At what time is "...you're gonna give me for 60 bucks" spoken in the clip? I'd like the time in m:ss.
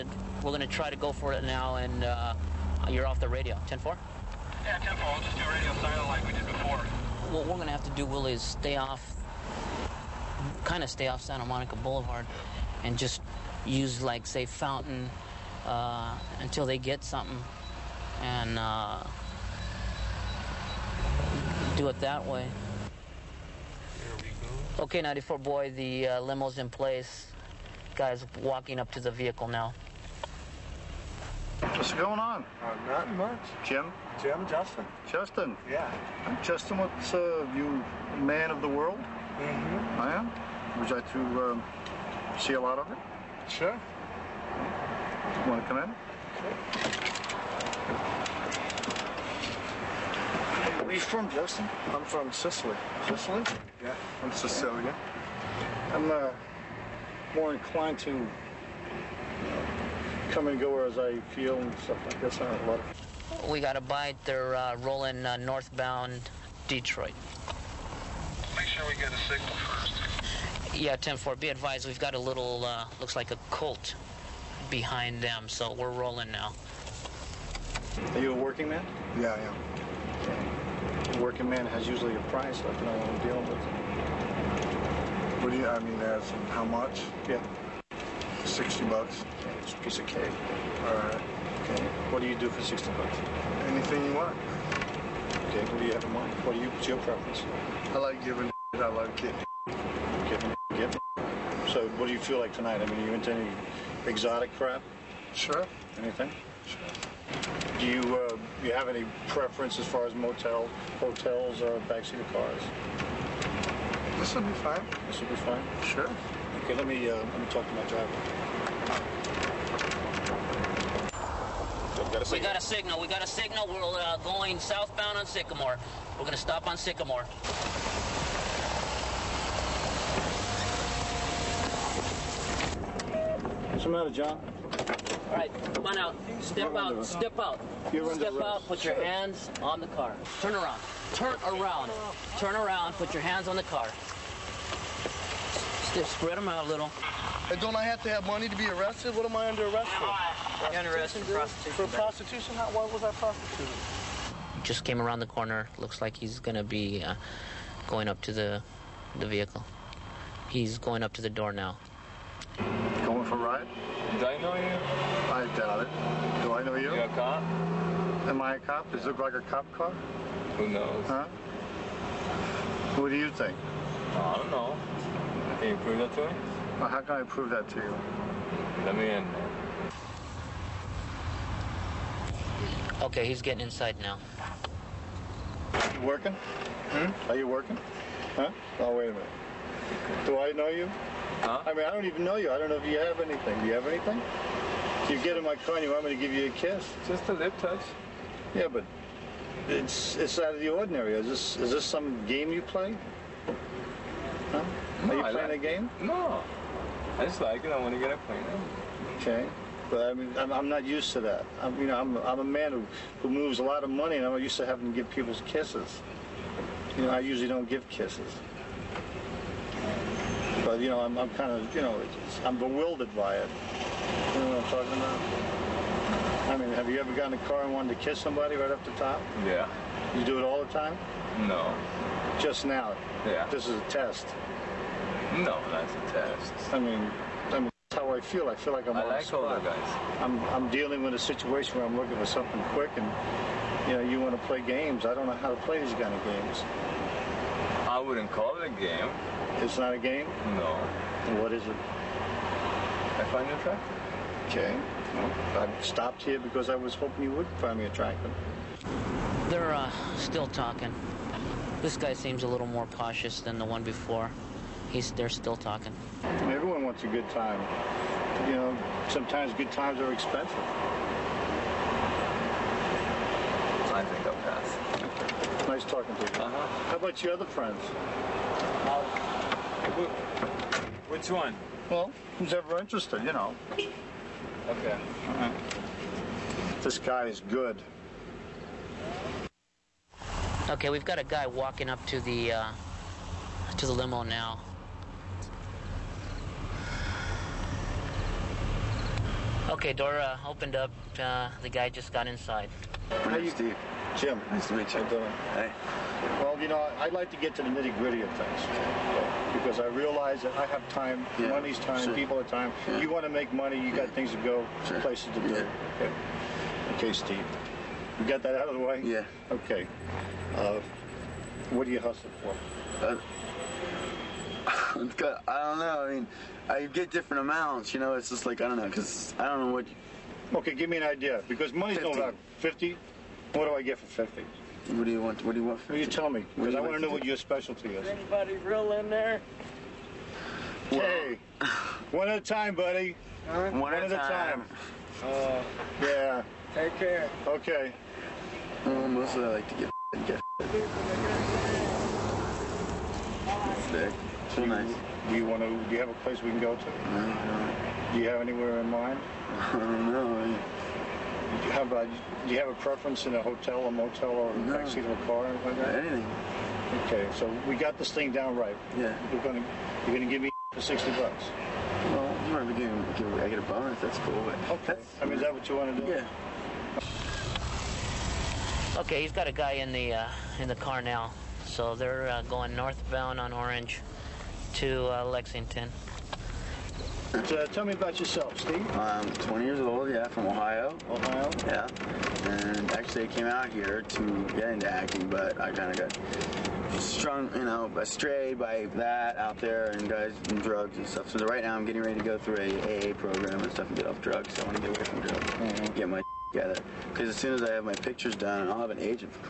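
6:10.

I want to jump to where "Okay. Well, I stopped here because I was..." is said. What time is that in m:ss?
4:14.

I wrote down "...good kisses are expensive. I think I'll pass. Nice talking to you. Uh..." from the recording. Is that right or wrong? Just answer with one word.
wrong.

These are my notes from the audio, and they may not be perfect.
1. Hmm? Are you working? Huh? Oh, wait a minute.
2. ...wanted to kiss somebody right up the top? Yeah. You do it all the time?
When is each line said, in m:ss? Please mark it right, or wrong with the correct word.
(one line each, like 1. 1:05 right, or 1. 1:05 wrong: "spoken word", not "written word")
1. 3:06 right
2. 3:47 right.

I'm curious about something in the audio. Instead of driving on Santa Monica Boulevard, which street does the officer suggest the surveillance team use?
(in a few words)
Fountain.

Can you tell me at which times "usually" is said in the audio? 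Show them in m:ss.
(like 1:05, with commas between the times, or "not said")
1:21, 3:37.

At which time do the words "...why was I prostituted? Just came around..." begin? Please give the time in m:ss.
2:32.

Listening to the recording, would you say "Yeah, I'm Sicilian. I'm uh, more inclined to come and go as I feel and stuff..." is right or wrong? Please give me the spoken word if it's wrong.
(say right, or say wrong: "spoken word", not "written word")
right.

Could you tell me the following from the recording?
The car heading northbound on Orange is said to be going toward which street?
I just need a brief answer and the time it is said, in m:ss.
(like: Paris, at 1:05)
Lexington, at 6:25.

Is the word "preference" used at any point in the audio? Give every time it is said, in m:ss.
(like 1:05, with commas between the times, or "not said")
1:36, 1:49, 6:02.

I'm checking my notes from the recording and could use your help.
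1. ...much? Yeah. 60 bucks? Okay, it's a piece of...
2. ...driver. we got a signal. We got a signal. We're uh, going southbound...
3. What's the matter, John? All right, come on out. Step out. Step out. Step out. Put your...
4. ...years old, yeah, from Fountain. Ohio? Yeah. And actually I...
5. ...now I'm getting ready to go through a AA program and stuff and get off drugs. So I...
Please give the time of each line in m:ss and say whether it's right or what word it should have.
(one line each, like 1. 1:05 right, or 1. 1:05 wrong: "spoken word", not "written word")
1. 1:26 right
2. 1:57 right
3. 2:13 right
4. 6:29 wrong: "Ohio", not "Fountain"
5. 6:41 right.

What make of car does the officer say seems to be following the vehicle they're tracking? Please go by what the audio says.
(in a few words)
Colt.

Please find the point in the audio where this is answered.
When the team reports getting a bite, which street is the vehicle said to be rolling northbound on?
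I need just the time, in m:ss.
1:06.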